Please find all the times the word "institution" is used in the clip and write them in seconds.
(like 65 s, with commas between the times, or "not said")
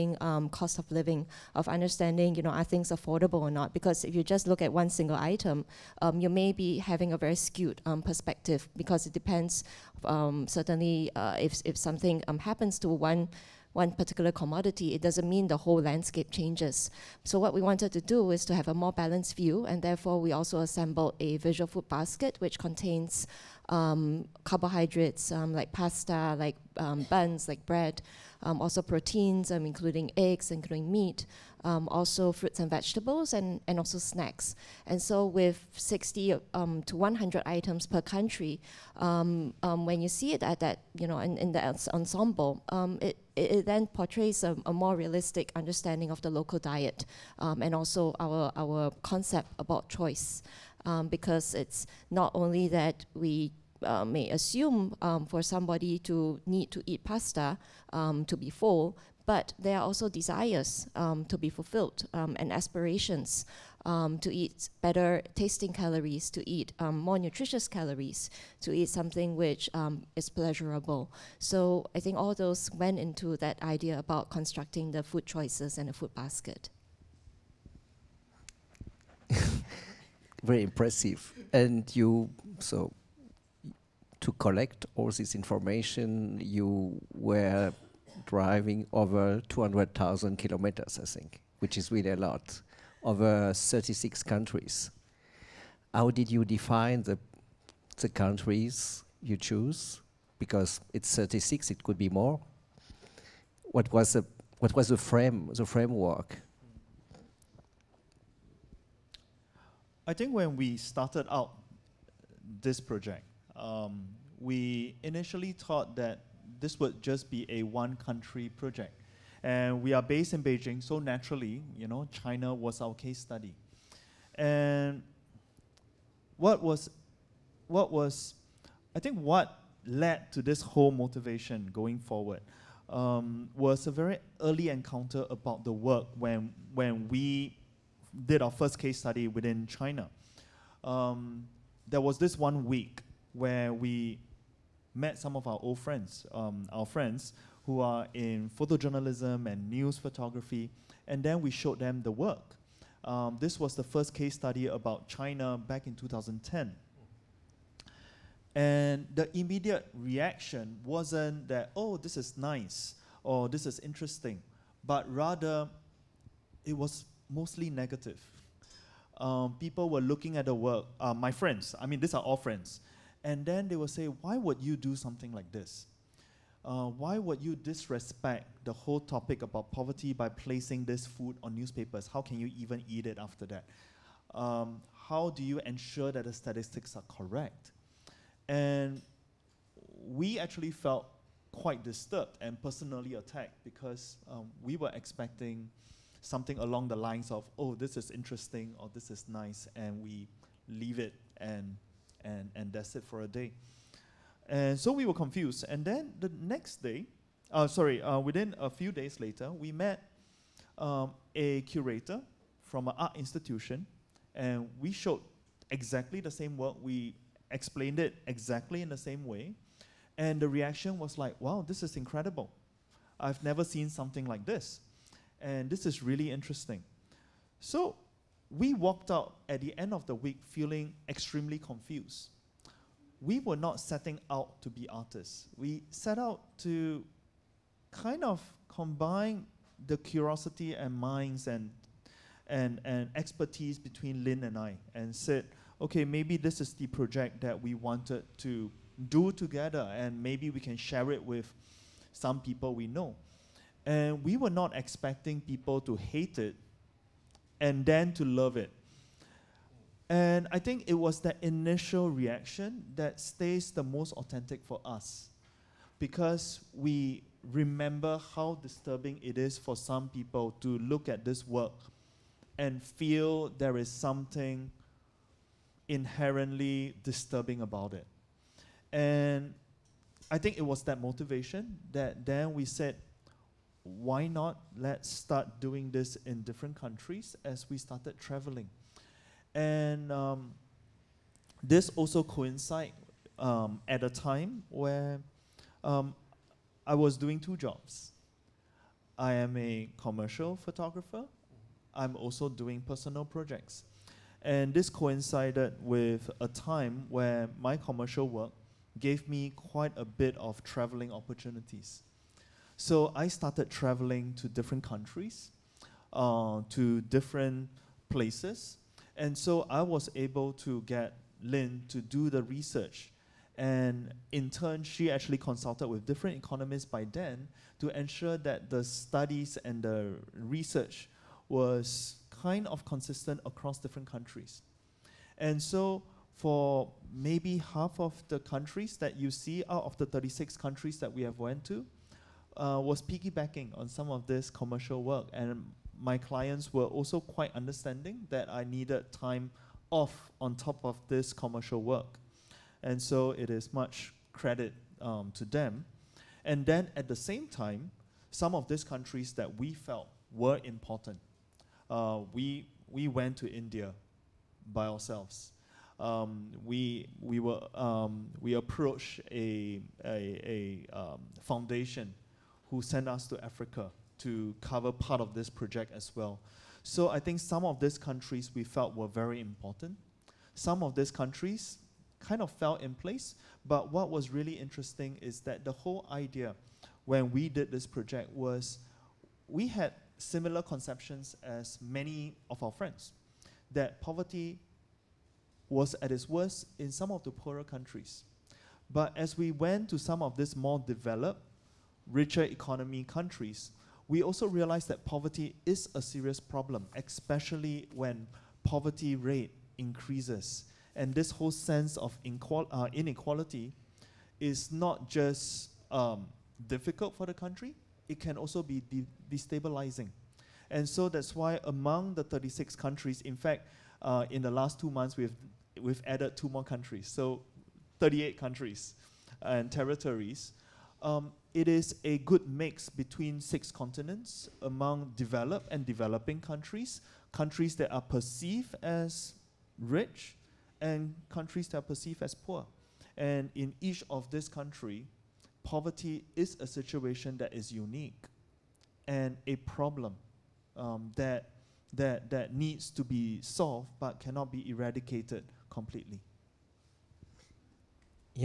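213 s.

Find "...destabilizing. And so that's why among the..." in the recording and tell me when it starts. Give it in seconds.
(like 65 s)
419 s.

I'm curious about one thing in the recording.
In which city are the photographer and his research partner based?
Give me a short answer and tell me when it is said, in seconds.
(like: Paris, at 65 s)
Beijing, at 120 s.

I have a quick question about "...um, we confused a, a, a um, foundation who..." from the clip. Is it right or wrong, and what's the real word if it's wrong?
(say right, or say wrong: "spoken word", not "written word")
wrong: "approached", not "confused".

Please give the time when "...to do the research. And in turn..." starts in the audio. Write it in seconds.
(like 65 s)
321 s.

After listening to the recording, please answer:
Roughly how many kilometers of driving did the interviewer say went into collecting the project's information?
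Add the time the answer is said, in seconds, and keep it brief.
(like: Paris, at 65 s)
200,000, at 89 s.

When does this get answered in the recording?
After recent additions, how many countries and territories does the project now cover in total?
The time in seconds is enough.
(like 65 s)
427 s.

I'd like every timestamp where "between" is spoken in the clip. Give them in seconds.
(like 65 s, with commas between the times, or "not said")
243 s, 432 s.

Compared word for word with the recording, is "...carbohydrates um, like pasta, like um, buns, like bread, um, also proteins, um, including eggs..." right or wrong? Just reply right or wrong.
right.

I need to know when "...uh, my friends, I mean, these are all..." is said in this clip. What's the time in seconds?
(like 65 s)
170 s.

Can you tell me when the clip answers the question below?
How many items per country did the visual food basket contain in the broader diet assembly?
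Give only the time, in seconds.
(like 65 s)
35 s.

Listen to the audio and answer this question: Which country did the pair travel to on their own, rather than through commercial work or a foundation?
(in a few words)
India.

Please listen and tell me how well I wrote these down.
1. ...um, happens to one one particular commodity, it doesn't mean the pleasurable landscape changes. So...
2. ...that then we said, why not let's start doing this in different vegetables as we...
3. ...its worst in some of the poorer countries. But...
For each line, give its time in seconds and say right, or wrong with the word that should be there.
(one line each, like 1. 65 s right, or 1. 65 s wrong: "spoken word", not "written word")
1. 12 s wrong: "whole", not "pleasurable"
2. 281 s wrong: "countries", not "vegetables"
3. 396 s right.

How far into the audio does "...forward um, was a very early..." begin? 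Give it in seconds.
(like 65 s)
131 s.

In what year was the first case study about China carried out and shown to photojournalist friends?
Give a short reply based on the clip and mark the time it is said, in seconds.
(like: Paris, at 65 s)
2010, at 155 s.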